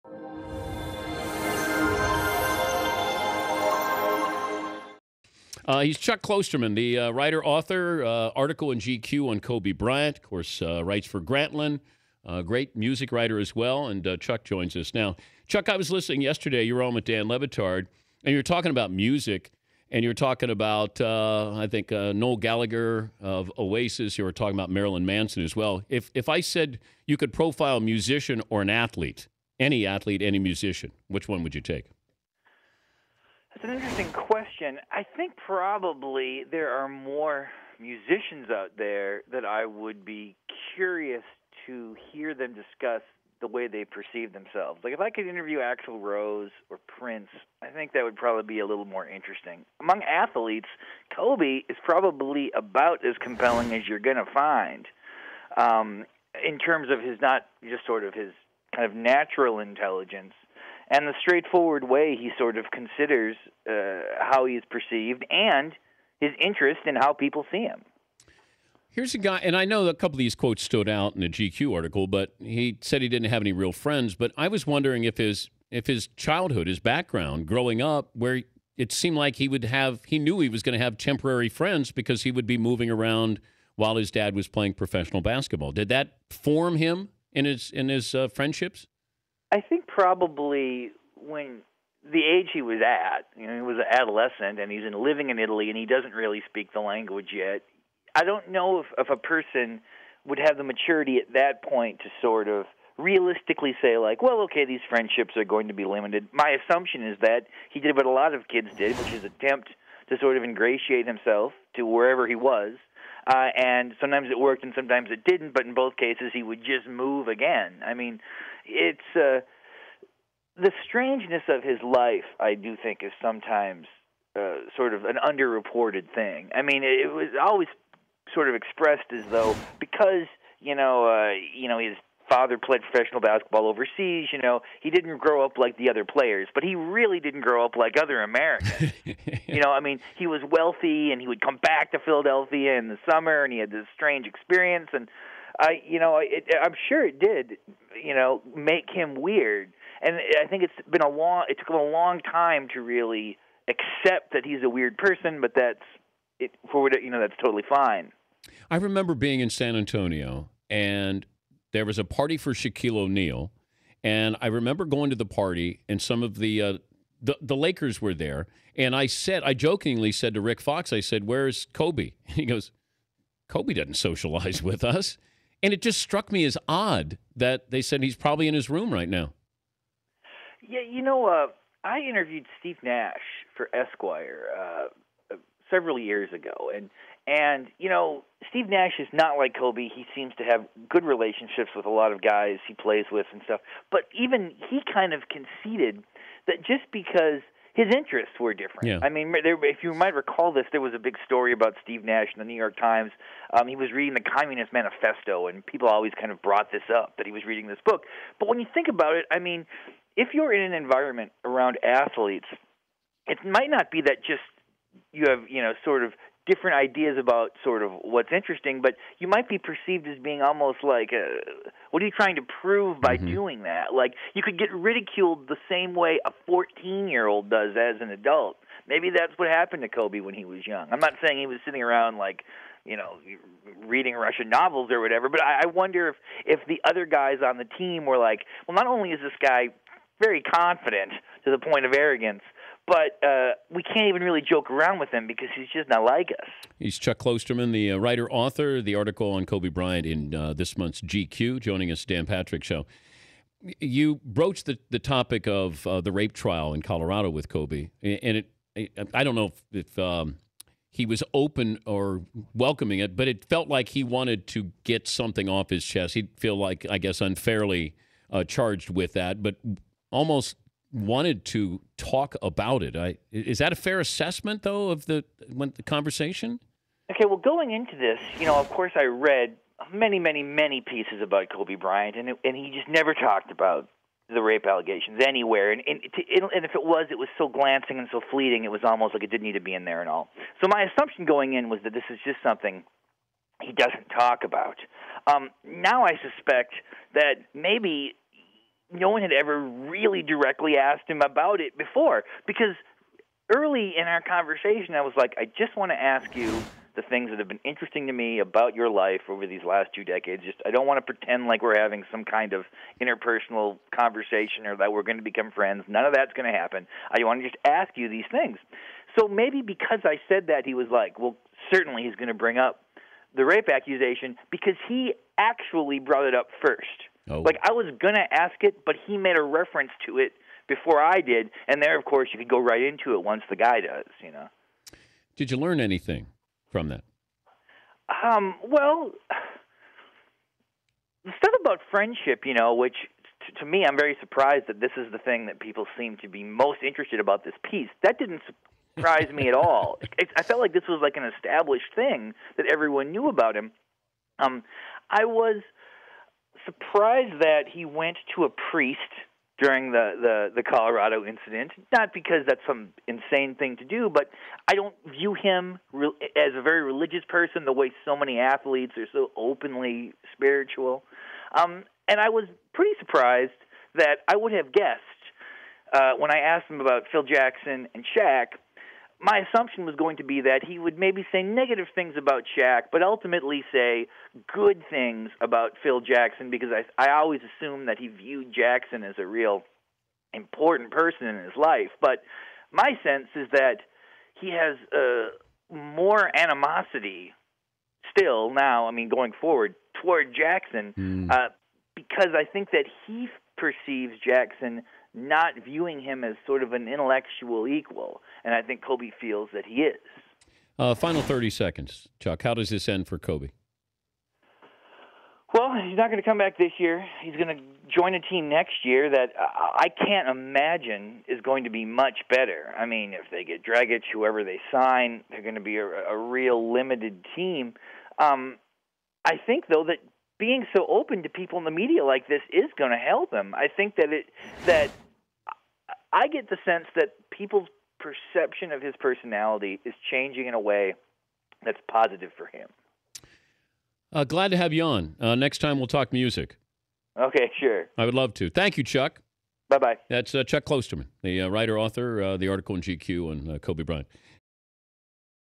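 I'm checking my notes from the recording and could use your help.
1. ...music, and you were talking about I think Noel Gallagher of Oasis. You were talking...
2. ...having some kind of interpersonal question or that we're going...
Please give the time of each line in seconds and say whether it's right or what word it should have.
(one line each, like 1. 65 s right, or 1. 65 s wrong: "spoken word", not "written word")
1. 18 s right
2. 311 s wrong: "conversation", not "question".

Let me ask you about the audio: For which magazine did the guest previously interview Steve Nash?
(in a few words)
Esquire.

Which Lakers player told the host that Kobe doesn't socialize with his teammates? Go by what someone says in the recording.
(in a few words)
Rick Fox.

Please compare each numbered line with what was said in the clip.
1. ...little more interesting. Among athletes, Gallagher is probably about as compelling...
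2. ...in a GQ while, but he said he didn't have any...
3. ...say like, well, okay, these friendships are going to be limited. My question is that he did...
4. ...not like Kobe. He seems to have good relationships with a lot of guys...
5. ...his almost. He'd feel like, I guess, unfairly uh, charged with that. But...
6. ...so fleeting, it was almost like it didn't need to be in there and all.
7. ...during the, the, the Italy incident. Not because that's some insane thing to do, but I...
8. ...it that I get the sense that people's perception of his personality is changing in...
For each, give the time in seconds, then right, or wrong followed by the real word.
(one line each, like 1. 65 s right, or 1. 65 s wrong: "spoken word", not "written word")
1. 48 s wrong: "Kobe", not "Gallagher"
2. 71 s wrong: "article", not "while"
3. 103 s wrong: "assumption", not "question"
4. 189 s right
5. 265 s wrong: "chest", not "almost"
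6. 288 s right
7. 359 s wrong: "Colorado", not "Italy"
8. 434 s right.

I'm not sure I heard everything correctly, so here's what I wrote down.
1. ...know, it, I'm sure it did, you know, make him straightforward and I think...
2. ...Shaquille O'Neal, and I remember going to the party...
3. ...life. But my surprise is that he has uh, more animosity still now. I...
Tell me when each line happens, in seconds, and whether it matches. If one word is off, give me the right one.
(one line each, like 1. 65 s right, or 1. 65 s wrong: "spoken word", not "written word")
1. 145 s wrong: "weird", not "straightforward"
2. 162 s right
3. 391 s wrong: "sense", not "surprise".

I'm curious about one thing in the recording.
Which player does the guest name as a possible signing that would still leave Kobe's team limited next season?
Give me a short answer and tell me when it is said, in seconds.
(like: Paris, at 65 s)
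Dragic, at 423 s.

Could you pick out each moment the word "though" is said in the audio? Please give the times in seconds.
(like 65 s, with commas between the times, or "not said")
129 s, 274 s, 429 s.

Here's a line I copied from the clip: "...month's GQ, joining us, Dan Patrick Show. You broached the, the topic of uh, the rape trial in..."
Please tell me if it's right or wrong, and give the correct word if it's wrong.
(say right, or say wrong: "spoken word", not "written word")
right.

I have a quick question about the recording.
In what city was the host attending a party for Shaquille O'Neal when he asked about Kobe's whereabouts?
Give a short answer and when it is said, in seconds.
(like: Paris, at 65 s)
San Antonio, at 159 s.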